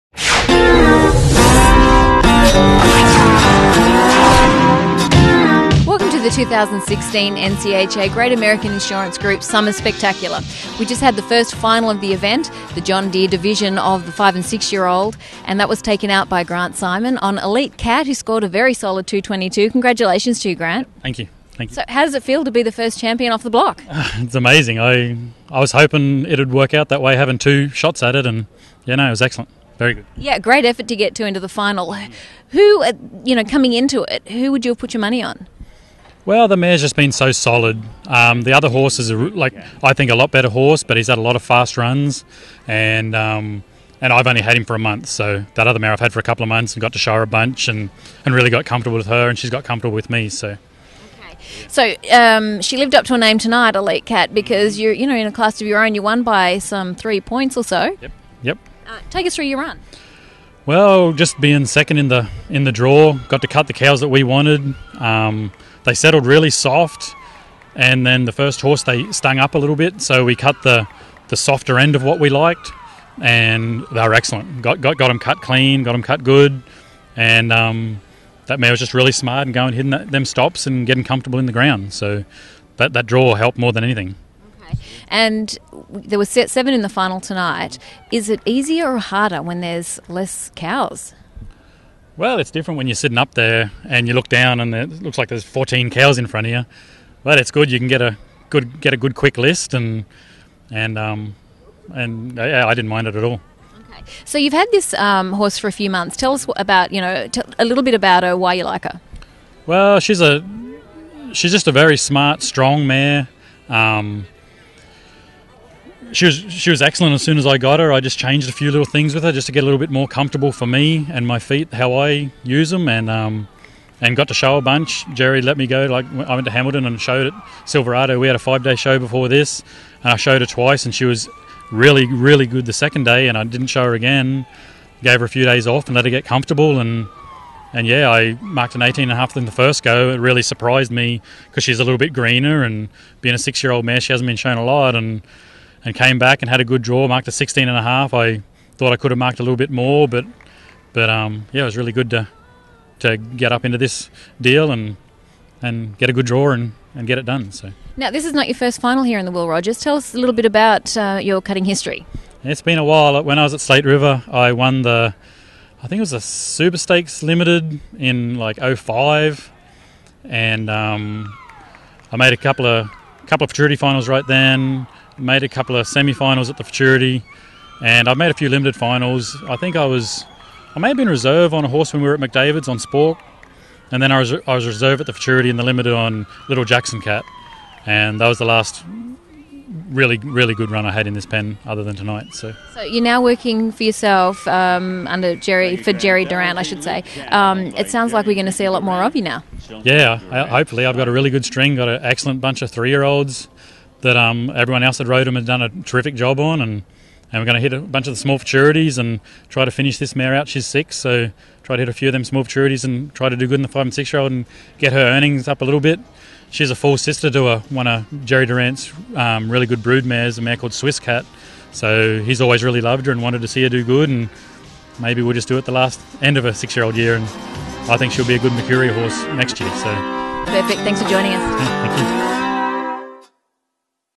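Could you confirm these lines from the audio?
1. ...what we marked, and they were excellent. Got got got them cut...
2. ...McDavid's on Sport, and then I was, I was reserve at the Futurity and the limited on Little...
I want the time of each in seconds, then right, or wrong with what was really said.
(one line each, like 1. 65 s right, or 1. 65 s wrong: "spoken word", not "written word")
1. 72 s wrong: "liked", not "marked"
2. 182 s right.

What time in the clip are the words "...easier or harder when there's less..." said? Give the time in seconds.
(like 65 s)
88 s.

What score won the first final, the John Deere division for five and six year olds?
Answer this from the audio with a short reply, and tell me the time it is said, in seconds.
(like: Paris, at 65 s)
222, at 19 s.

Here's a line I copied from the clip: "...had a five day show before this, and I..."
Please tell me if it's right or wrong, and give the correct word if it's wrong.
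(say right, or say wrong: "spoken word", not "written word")
right.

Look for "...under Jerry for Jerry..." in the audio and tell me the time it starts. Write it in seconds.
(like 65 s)
195 s.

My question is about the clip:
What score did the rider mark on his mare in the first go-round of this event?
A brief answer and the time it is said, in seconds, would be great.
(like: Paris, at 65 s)
218.5, at 138 s.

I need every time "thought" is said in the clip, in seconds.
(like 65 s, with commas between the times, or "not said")
148 s.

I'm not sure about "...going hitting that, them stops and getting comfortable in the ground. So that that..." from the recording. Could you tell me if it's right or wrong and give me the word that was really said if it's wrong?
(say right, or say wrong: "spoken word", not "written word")
right.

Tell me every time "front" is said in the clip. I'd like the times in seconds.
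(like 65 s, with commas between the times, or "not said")
96 s.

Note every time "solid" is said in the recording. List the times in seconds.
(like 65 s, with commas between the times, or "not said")
18 s, 37 s.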